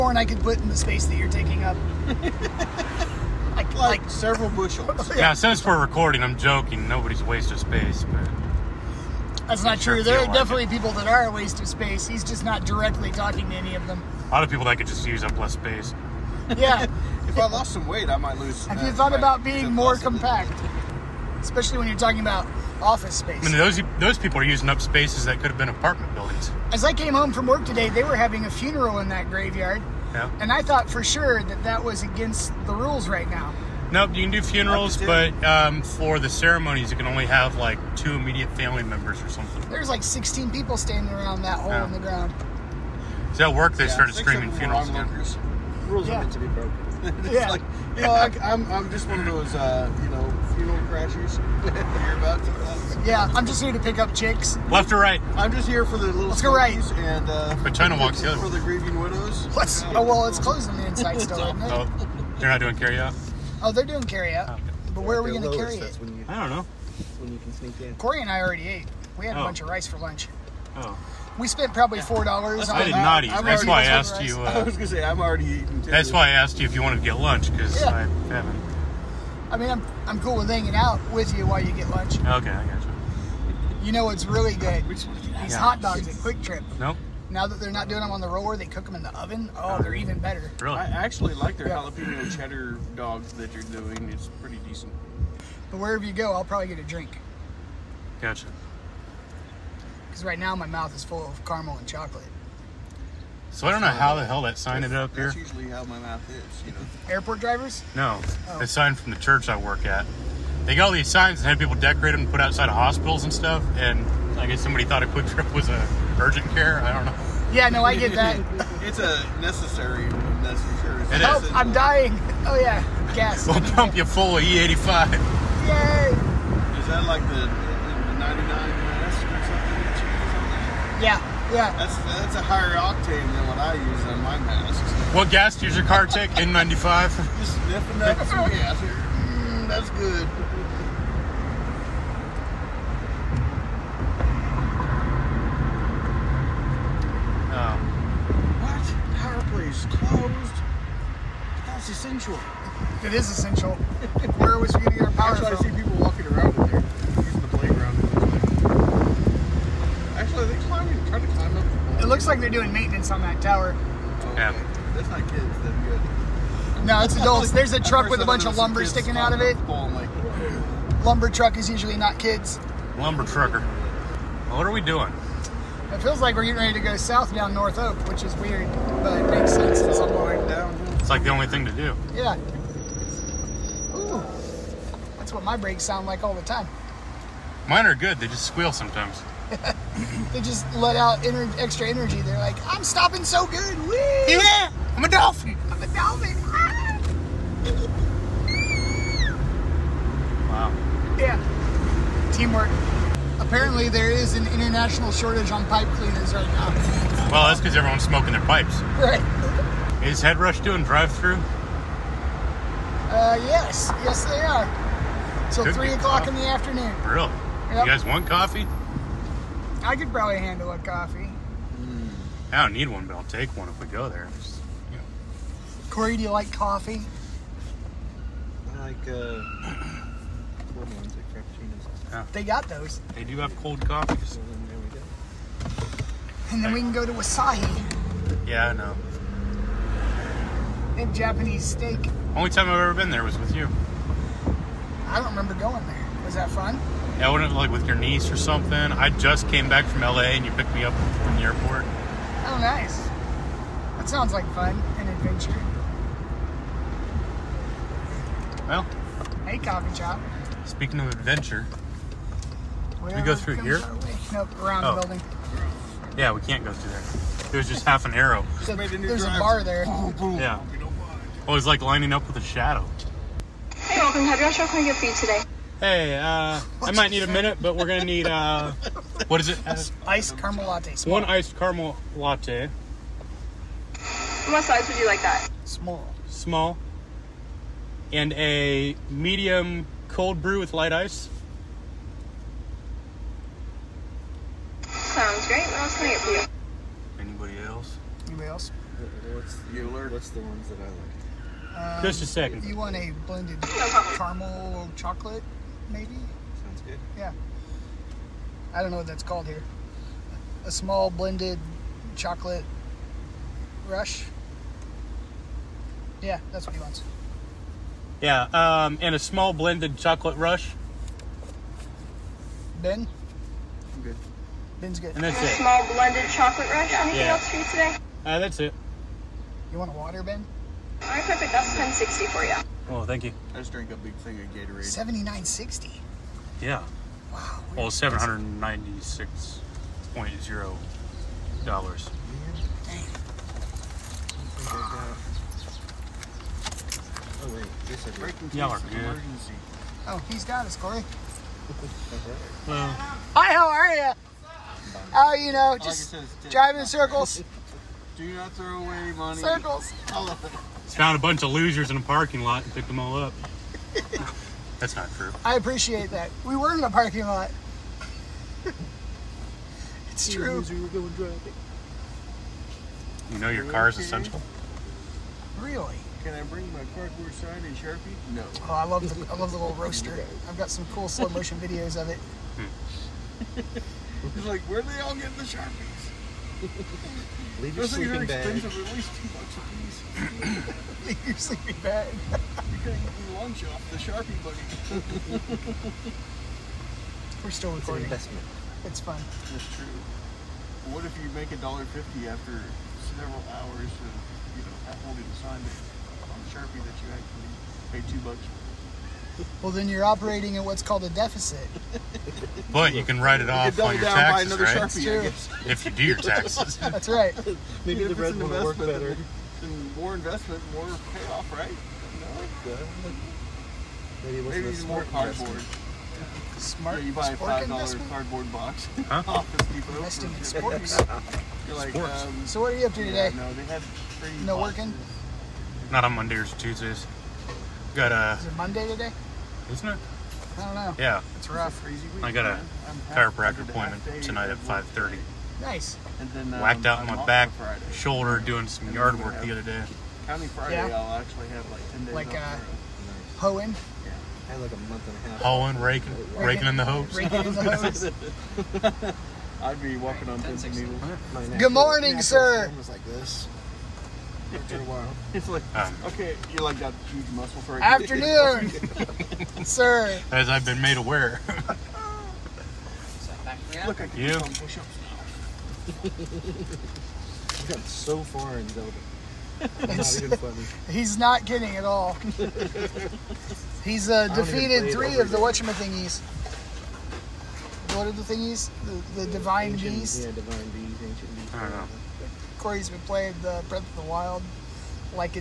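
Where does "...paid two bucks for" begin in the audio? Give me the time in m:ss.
6:47.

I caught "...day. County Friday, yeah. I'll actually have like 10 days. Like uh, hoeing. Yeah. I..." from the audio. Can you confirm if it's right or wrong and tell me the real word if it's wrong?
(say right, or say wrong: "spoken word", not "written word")
right.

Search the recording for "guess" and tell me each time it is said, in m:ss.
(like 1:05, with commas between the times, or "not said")
1:54, 6:55.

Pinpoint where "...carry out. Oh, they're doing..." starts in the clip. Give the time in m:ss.
1:02.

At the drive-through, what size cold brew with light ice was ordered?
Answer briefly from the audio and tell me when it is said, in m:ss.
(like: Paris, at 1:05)
Medium, at 4:49.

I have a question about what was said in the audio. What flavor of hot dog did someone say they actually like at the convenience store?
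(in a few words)
Jalapeno cheddar.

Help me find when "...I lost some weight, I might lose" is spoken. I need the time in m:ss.
0:17.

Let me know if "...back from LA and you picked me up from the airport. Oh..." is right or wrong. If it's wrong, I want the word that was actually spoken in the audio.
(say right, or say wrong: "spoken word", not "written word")
right.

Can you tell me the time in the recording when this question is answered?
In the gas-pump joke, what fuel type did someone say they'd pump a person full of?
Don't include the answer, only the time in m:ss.
2:04.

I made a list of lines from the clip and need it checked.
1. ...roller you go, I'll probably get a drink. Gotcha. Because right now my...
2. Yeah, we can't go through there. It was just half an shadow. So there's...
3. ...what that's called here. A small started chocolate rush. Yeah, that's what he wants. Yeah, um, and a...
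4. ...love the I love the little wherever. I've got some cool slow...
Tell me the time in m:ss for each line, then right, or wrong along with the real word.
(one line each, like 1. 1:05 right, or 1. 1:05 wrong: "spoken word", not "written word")
1. 1:35 wrong: "wherever", not "roller"
2. 4:26 wrong: "arrow", not "shadow"
3. 5:08 wrong: "blended", not "started"
4. 6:18 wrong: "roaster", not "wherever".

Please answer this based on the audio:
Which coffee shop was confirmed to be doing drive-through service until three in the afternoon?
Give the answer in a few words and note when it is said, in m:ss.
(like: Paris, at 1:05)
Head Rush, at 3:30.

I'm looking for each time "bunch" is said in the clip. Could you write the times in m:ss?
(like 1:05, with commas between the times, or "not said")
1:09, 2:48, 6:01.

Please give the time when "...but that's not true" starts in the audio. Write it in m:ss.
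0:08.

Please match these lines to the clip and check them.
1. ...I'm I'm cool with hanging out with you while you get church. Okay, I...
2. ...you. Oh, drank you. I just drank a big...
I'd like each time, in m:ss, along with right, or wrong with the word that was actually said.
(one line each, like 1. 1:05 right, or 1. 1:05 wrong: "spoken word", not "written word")
1. 1:19 wrong: "lunch", not "church"
2. 5:32 wrong: "thank", not "drank".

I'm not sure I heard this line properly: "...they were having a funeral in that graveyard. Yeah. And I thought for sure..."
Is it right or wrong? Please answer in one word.
right.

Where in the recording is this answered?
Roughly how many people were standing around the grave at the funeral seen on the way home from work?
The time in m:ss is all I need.
0:40.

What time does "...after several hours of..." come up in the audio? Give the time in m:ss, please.
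6:42.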